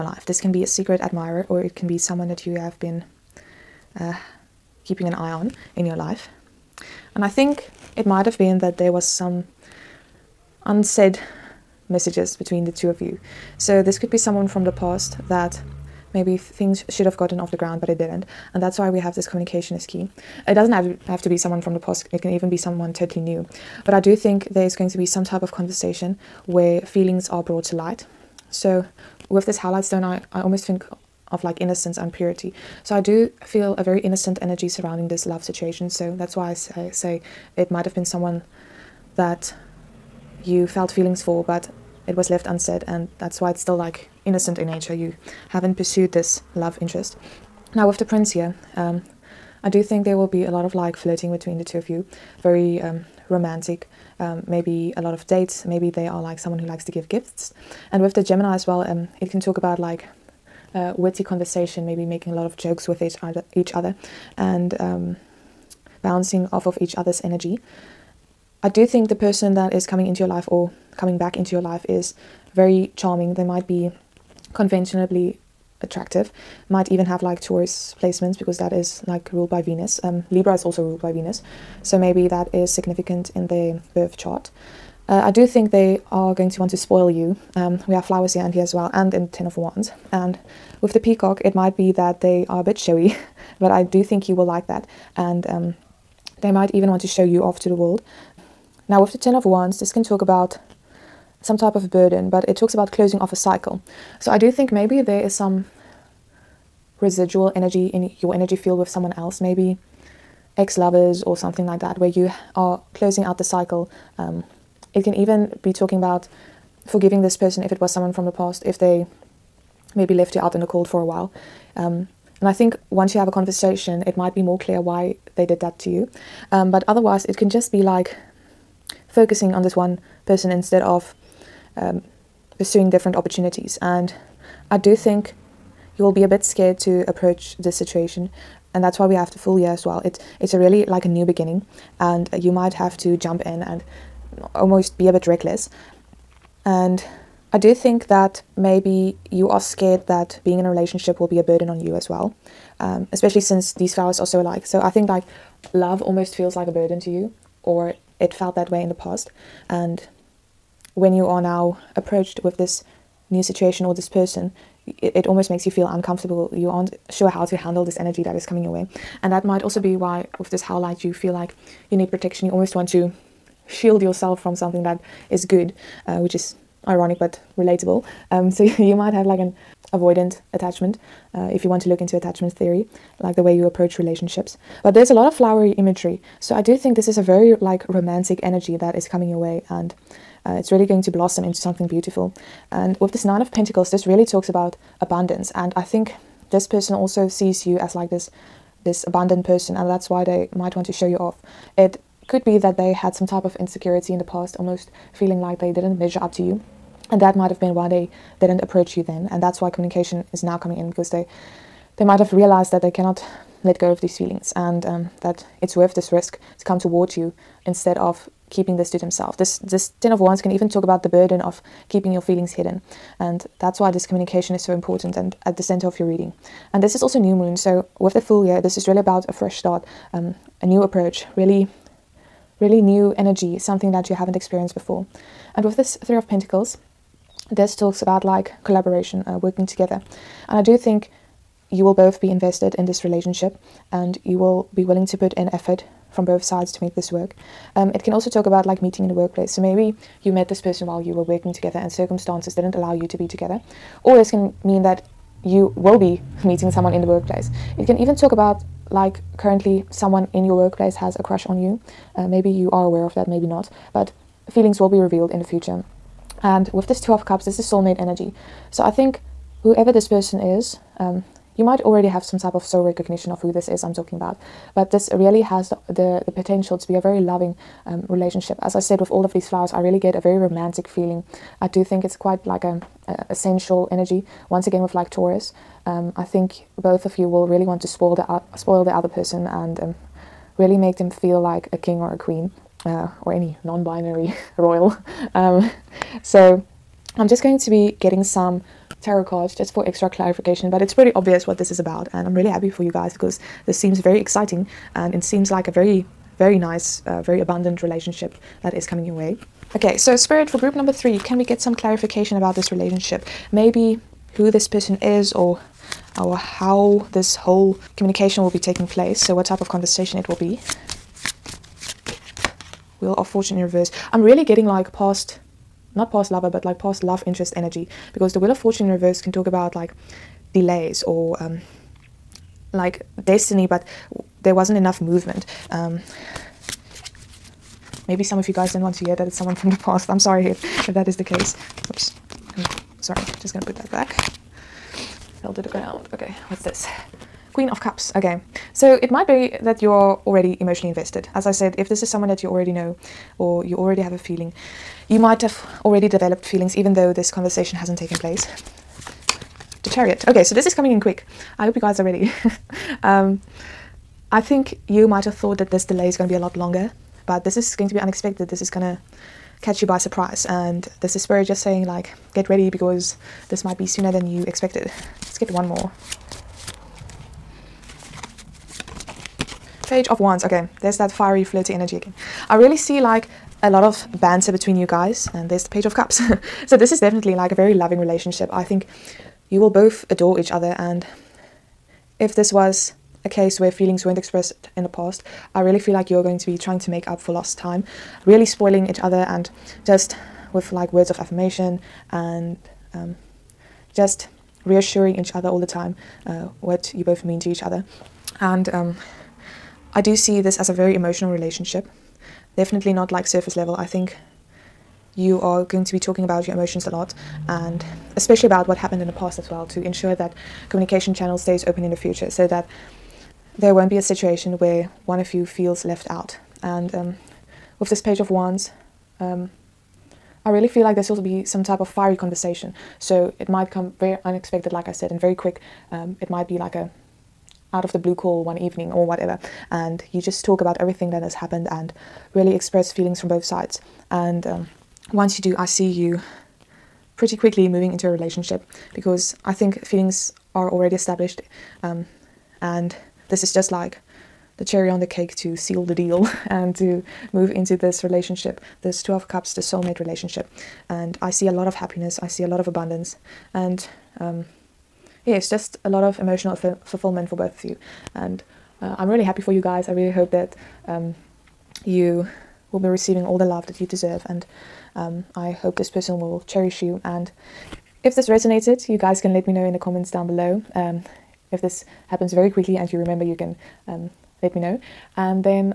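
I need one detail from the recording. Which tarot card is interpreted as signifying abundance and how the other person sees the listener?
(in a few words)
Nine of Pentacles.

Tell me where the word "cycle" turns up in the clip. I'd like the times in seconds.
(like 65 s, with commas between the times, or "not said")
103 s, 113 s.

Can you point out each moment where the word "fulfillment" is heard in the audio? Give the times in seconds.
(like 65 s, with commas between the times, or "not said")
466 s.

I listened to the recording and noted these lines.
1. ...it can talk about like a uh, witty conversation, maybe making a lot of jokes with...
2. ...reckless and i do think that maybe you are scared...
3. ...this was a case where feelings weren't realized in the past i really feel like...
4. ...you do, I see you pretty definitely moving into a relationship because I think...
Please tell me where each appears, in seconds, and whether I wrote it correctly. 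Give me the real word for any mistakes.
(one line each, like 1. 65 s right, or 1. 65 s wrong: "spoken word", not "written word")
1. 59 s right
2. 145 s right
3. 392 s wrong: "expressed", not "realized"
4. 445 s wrong: "quickly", not "definitely".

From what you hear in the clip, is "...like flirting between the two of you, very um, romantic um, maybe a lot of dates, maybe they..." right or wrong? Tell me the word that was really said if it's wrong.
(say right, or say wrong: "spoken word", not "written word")
right.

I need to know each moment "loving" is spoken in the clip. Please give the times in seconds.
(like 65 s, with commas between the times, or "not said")
277 s, 387 s.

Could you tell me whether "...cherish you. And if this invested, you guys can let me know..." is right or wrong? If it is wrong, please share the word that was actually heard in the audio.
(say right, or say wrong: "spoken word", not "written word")
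wrong: "resonated", not "invested".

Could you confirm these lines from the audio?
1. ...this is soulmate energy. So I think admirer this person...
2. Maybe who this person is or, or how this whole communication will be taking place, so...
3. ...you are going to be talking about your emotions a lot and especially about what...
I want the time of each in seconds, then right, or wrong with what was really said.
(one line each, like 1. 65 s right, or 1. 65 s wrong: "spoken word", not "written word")
1. 267 s wrong: "whoever", not "admirer"
2. 313 s right
3. 415 s right.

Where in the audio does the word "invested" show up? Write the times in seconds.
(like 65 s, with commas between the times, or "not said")
242 s, 350 s.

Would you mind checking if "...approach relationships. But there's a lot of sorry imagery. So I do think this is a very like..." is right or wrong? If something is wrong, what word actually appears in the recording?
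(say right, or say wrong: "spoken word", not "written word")
wrong: "flowery", not "sorry".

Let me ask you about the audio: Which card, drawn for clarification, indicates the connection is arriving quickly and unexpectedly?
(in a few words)
The Chariot.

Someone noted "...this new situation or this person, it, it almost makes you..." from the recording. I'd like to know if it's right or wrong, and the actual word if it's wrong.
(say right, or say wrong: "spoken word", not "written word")
right.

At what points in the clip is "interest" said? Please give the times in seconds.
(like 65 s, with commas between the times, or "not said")
46 s, 327 s.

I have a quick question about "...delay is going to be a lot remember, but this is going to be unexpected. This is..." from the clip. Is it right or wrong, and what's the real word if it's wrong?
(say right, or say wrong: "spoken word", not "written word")
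wrong: "longer", not "remember".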